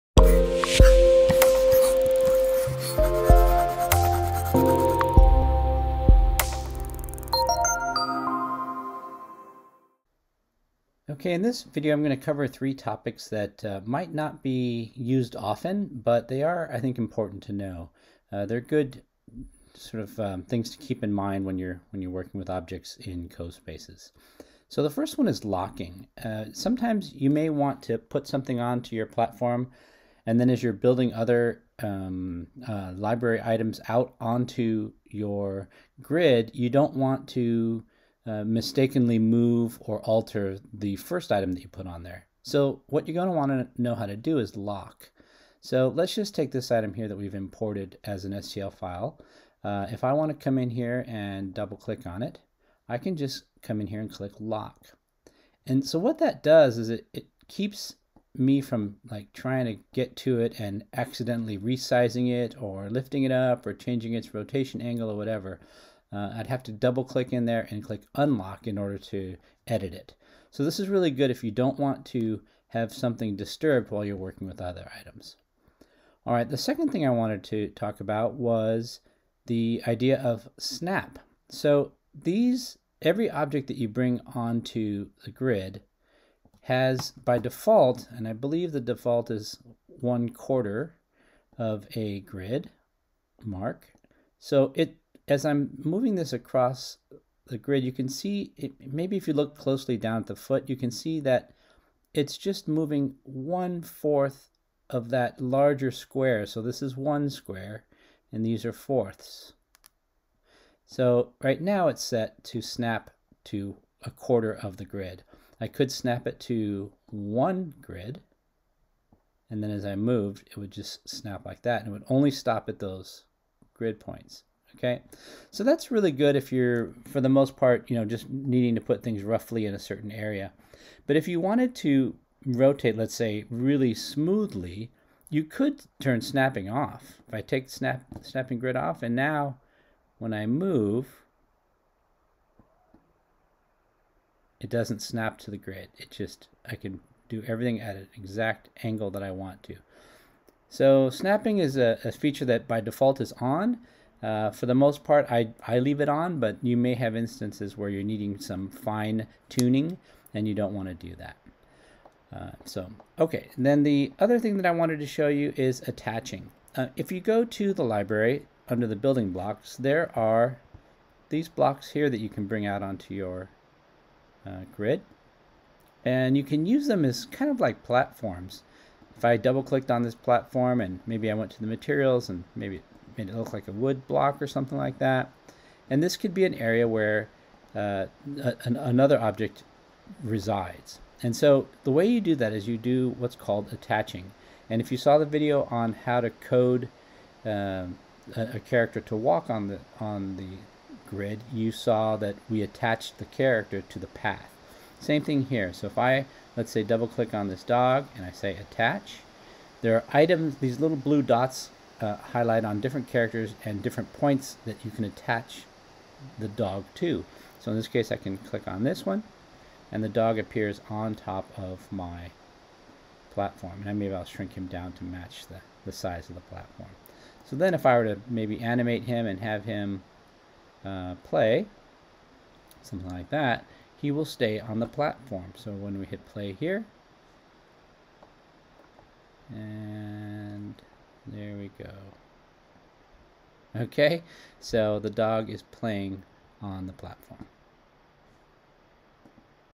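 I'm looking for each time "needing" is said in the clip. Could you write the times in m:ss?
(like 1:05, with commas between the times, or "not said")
2:08, 2:38.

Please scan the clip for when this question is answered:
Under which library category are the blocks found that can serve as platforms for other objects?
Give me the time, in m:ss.
2:48.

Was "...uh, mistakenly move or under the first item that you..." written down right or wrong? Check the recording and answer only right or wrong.
wrong.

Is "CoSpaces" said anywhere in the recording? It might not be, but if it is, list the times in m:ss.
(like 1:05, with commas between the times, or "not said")
0:23.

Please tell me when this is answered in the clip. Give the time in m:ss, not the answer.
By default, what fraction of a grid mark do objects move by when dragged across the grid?
1:29.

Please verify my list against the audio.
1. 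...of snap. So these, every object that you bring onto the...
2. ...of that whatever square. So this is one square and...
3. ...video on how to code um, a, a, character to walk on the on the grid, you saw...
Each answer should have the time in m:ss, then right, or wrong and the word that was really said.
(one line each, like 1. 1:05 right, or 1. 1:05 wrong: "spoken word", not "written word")
1. 1:20 right
2. 1:44 wrong: "larger", not "whatever"
3. 3:15 right.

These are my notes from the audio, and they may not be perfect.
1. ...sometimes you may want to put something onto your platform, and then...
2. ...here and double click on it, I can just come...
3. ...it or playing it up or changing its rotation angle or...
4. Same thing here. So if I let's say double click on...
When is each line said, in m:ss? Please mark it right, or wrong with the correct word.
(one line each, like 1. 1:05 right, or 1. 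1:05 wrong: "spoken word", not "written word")
1. 0:26 right
2. 0:50 right
3. 1:02 wrong: "lifting", not "playing"
4. 3:24 right.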